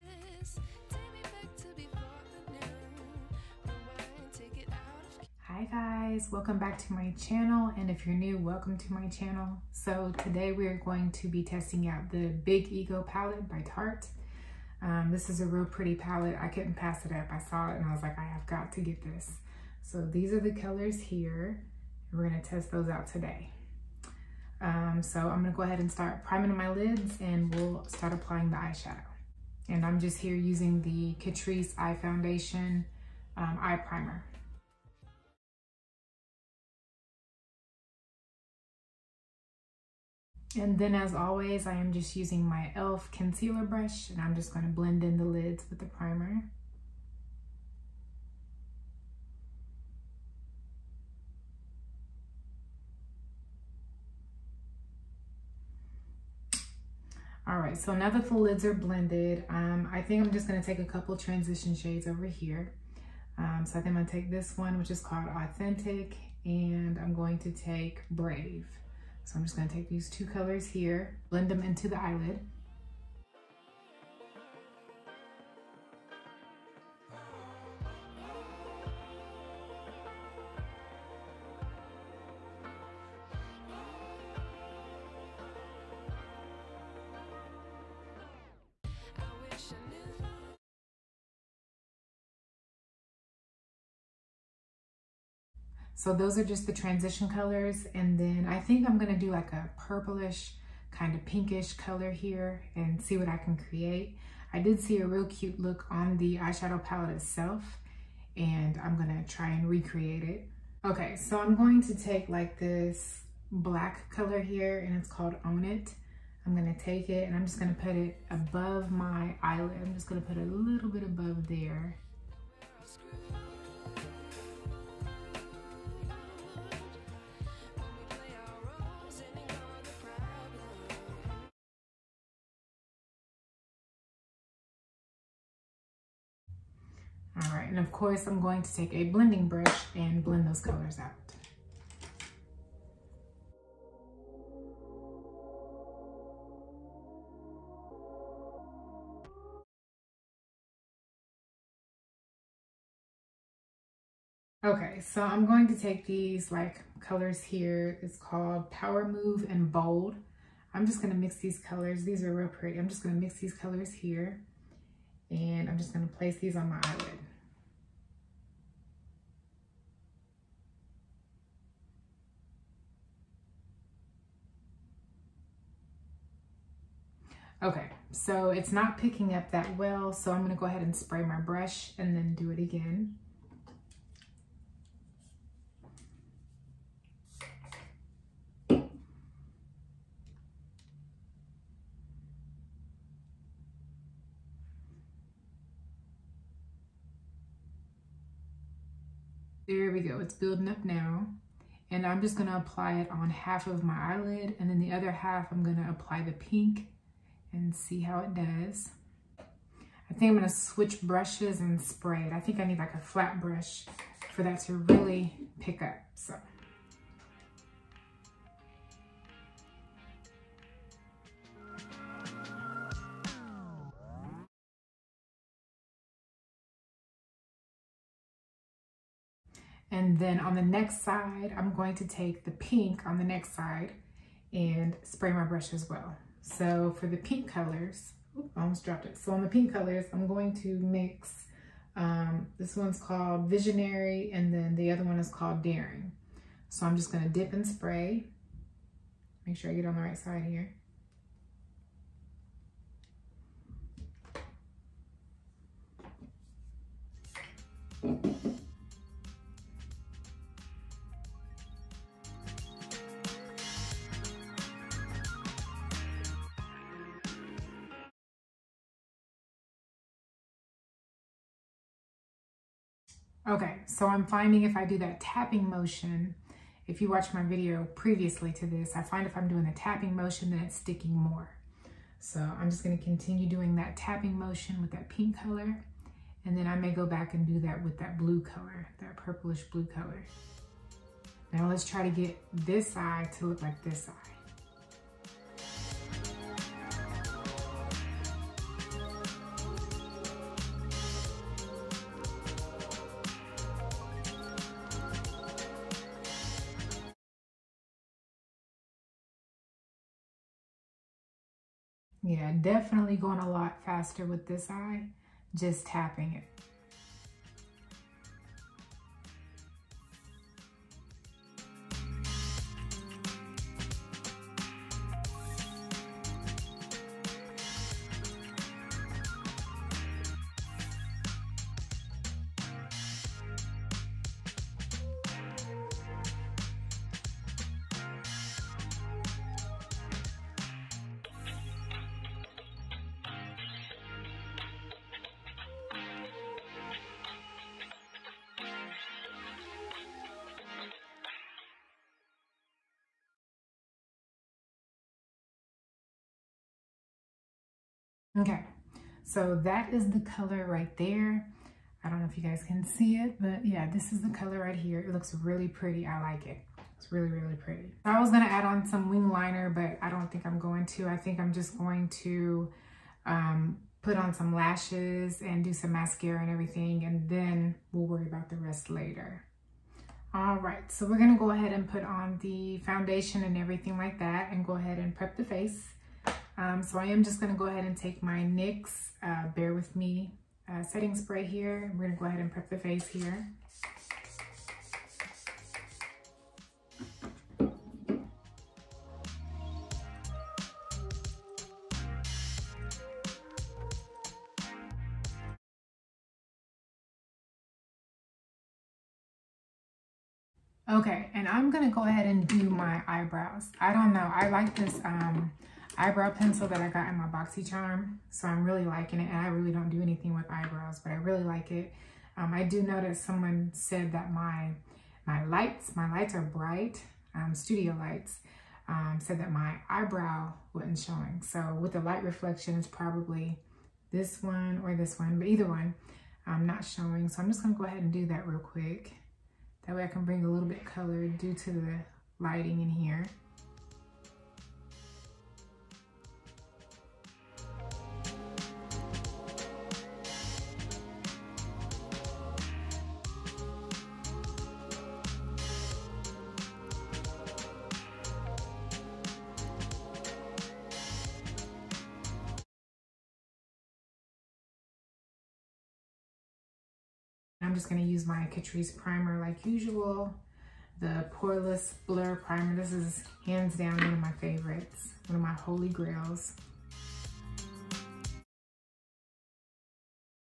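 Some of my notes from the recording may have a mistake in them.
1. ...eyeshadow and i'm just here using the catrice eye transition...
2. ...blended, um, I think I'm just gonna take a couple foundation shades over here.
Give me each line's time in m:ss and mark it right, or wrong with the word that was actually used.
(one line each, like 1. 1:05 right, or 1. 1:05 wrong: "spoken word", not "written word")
1. 0:28 wrong: "foundation", not "transition"
2. 0:58 wrong: "transition", not "foundation".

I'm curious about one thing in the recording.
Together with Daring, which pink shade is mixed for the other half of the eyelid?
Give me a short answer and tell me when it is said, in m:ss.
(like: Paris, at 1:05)
Visionary, at 4:03.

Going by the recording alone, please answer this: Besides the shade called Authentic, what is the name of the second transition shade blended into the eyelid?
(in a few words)
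Brave.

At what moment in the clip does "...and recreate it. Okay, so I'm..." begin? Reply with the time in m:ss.
1:49.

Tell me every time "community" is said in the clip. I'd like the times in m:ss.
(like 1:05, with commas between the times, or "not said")
not said.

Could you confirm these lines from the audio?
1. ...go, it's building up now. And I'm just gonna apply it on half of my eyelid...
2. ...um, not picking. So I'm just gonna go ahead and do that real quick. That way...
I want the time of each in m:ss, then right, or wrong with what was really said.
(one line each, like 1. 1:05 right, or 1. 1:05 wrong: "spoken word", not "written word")
1. 3:20 right
2. 7:16 wrong: "showing", not "picking".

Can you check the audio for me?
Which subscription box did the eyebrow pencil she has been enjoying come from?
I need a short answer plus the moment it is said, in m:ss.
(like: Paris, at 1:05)
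BoxyCharm, at 6:57.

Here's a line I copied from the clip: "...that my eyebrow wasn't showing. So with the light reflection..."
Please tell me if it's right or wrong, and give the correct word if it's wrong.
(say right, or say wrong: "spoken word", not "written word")
right.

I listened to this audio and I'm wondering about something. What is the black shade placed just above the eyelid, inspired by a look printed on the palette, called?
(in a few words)
Own It.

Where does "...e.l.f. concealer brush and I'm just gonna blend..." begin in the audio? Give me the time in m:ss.
0:42.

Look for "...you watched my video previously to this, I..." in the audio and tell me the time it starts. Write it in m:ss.
4:37.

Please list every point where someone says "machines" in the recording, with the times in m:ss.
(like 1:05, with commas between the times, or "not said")
not said.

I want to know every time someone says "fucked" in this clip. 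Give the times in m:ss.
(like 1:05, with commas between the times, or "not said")
not said.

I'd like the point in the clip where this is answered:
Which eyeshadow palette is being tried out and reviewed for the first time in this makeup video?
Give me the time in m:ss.
0:12.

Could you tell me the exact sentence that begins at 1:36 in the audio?
So those are just the transition colors.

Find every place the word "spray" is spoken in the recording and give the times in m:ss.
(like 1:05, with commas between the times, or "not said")
3:00, 3:31, 3:55, 4:07, 6:31.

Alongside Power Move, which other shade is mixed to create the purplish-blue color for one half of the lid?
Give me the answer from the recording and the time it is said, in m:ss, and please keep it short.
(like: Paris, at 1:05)
Bold, at 2:39.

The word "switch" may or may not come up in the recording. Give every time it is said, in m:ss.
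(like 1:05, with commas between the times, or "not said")
3:30.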